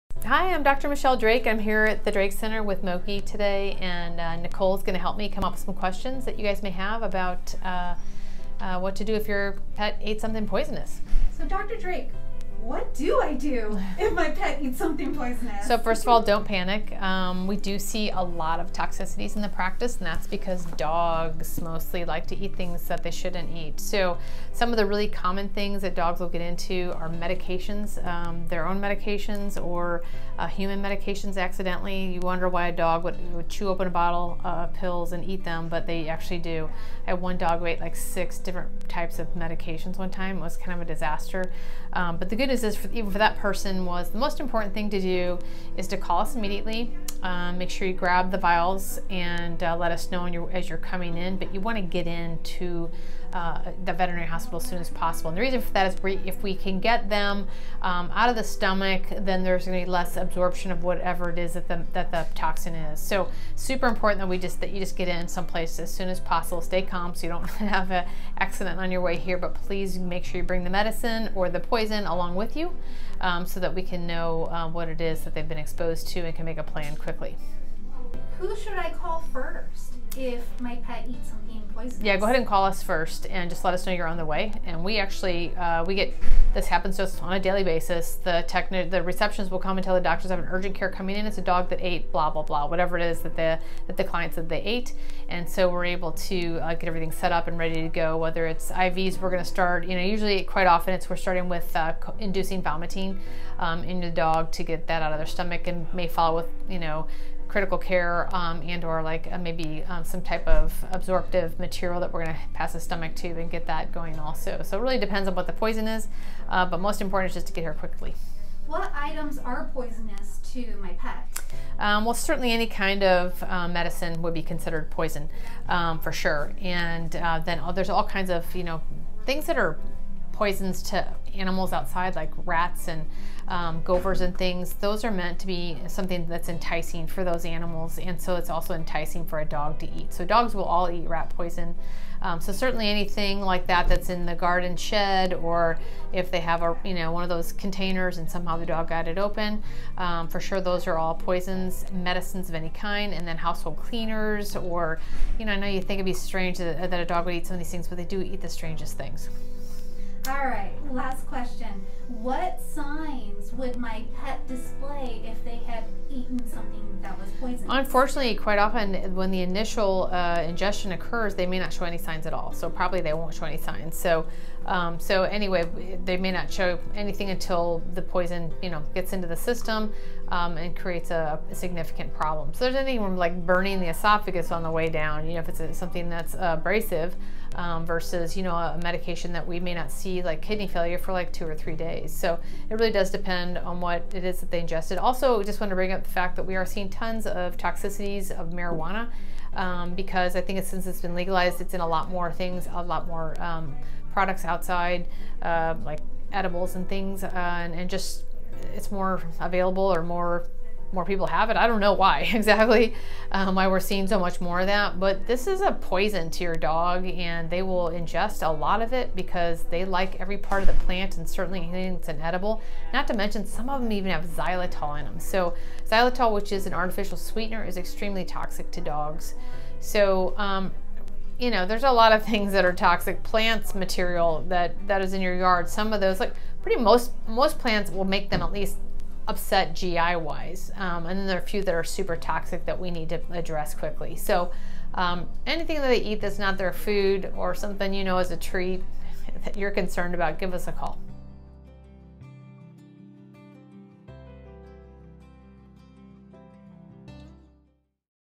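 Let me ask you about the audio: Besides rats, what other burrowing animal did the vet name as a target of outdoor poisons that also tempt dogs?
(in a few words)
Gophers.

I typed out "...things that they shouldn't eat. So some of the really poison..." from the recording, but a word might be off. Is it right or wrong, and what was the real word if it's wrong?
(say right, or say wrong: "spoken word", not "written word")
wrong: "common", not "poison".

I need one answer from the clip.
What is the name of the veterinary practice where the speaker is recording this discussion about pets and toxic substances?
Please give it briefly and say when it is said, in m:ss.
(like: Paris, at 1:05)
Drake Center, at 0:02.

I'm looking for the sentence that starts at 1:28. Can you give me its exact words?
The techni- the receptions will come and tell the doctors I have an urgent care coming in.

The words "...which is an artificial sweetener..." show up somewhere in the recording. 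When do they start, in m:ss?
3:46.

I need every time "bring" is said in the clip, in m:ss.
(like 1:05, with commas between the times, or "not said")
1:10, 3:15.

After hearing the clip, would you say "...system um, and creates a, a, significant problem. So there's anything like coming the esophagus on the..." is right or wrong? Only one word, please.
wrong.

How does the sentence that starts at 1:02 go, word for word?
So super important that we just that you just get in someplace as soon as possible.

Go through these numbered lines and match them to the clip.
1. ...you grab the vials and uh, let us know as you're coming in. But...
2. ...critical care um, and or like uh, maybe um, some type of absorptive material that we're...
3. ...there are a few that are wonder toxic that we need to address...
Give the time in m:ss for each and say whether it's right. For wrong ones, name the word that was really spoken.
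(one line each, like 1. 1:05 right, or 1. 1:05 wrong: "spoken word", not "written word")
1. 0:47 right
2. 1:47 right
3. 4:01 wrong: "super", not "wonder".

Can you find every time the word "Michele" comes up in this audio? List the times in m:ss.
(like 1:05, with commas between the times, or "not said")
0:00.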